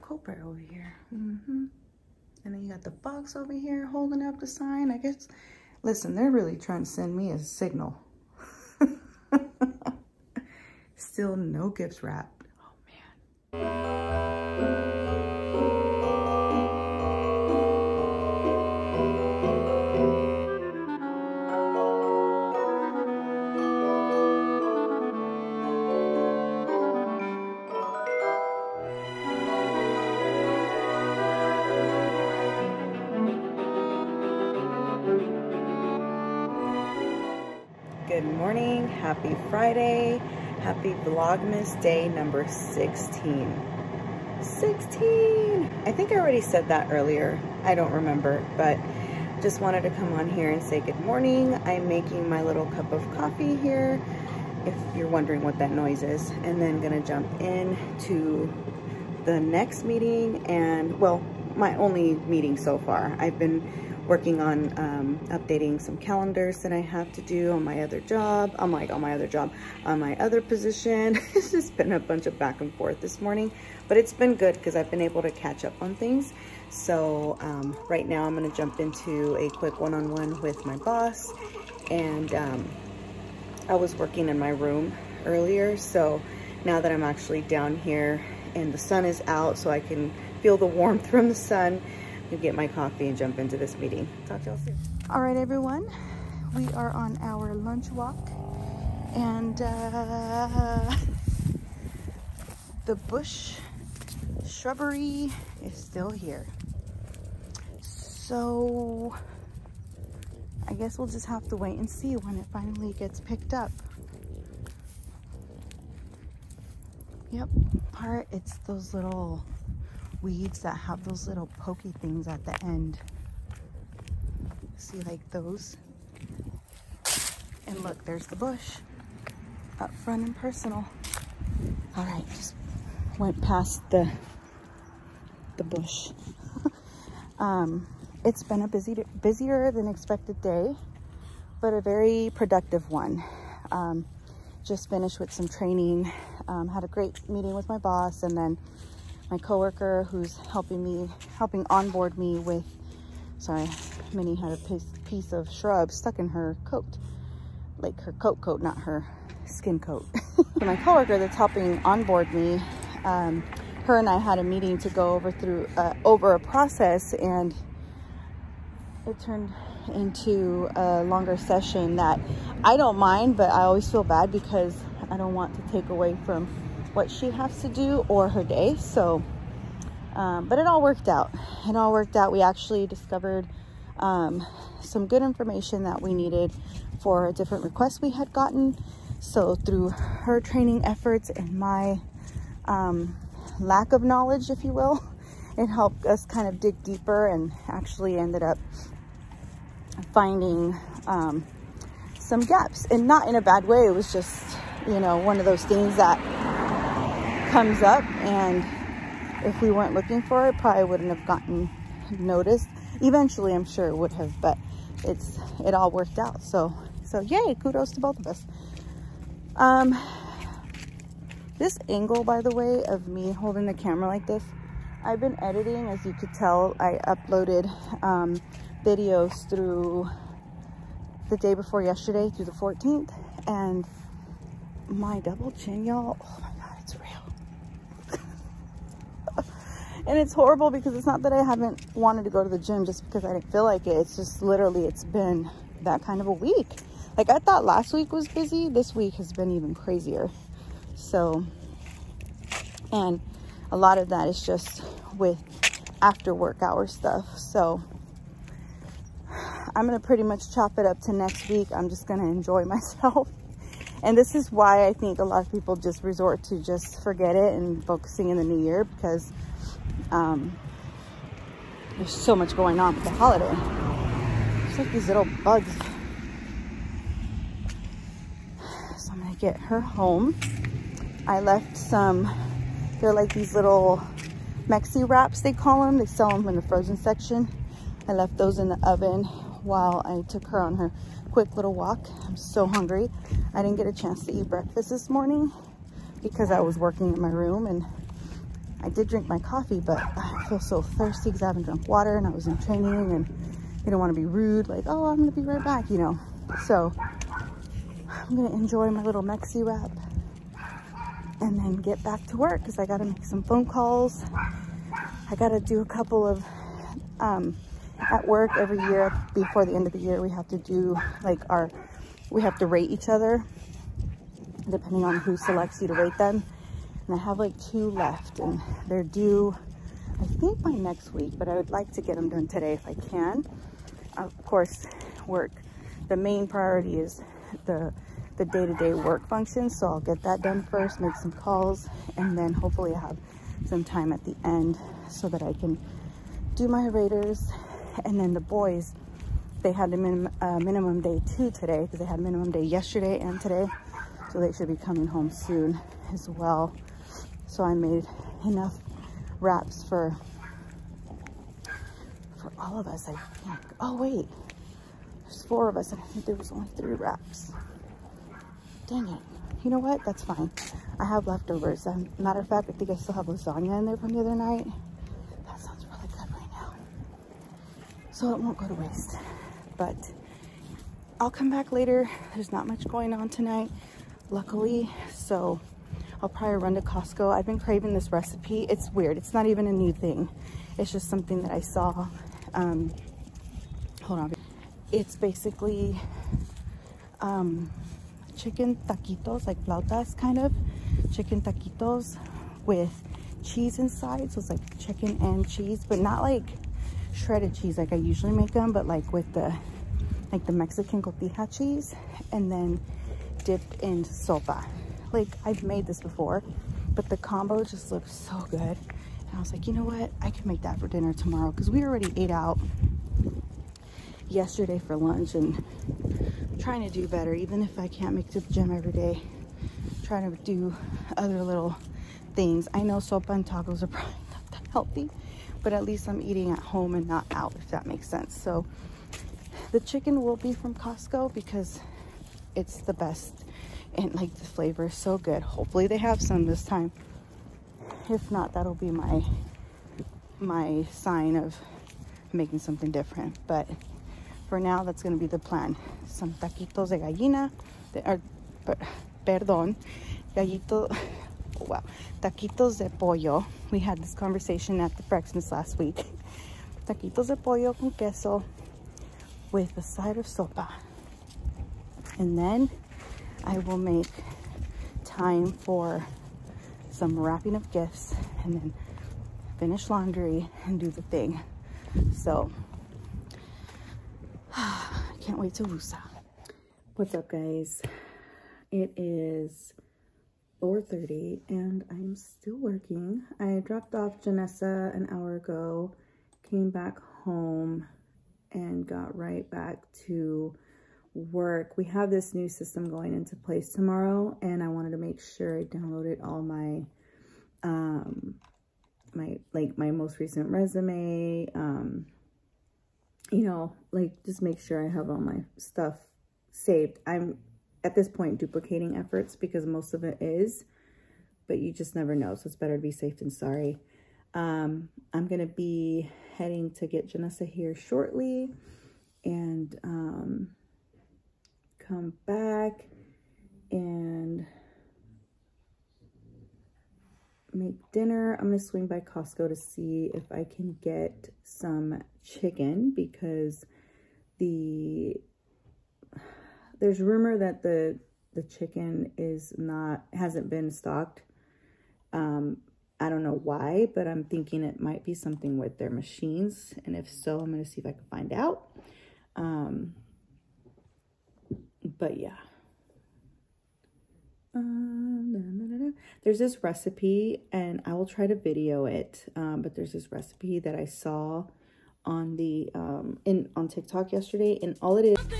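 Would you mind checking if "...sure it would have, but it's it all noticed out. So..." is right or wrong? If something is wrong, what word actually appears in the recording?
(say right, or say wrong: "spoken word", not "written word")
wrong: "worked", not "noticed".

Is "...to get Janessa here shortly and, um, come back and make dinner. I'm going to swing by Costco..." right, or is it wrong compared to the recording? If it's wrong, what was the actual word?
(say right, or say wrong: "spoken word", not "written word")
right.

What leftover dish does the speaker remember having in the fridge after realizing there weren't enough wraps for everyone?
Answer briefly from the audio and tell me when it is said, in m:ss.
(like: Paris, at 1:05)
lasagna, at 6:13.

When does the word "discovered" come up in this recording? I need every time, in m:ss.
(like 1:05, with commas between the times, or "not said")
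3:02.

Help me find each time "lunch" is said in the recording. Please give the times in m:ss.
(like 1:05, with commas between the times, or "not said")
1:37, 7:04.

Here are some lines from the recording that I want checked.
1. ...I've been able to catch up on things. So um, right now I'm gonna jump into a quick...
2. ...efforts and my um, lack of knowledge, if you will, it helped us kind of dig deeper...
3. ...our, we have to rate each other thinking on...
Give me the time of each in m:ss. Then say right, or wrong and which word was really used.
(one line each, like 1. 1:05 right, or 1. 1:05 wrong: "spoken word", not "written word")
1. 1:14 right
2. 3:10 right
3. 5:21 wrong: "depending", not "thinking".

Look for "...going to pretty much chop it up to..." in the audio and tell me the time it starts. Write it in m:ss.
4:19.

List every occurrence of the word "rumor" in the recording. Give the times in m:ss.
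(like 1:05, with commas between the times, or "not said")
9:07.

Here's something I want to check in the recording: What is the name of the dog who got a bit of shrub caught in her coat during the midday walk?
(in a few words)
Minnie.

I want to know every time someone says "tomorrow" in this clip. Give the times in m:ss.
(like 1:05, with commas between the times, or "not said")
7:01, 8:23.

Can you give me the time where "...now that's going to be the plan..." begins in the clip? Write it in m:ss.
7:34.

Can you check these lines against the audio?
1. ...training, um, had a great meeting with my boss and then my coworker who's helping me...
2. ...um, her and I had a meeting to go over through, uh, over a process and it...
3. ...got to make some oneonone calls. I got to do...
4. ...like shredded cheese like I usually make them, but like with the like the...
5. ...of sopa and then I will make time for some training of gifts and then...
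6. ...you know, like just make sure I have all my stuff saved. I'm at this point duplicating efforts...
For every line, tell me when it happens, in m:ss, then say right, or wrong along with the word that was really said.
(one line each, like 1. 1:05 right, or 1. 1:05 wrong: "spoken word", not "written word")
1. 2:25 right
2. 2:43 right
3. 5:12 wrong: "phone", not "oneonone"
4. 6:46 right
5. 7:50 wrong: "wrapping", not "training"
6. 8:33 right.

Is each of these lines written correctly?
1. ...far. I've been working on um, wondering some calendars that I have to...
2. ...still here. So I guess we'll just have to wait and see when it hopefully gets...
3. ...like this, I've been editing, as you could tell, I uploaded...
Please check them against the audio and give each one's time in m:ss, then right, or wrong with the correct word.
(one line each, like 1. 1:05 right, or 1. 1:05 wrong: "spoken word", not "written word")
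1. 1:02 wrong: "updating", not "wondering"
2. 1:45 wrong: "finally", not "hopefully"
3. 3:44 right.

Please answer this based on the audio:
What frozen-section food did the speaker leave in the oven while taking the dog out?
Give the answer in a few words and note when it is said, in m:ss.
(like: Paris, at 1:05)
Mexi wraps, at 4:44.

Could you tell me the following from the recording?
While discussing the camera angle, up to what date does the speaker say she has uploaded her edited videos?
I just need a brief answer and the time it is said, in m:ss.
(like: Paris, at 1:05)
the 14th, at 3:52.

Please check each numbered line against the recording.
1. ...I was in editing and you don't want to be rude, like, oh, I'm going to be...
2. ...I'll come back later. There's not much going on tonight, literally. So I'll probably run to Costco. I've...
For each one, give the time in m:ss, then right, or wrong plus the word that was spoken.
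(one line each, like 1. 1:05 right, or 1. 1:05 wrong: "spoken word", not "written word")
1. 5:02 wrong: "training", not "editing"
2. 6:21 wrong: "luckily", not "literally".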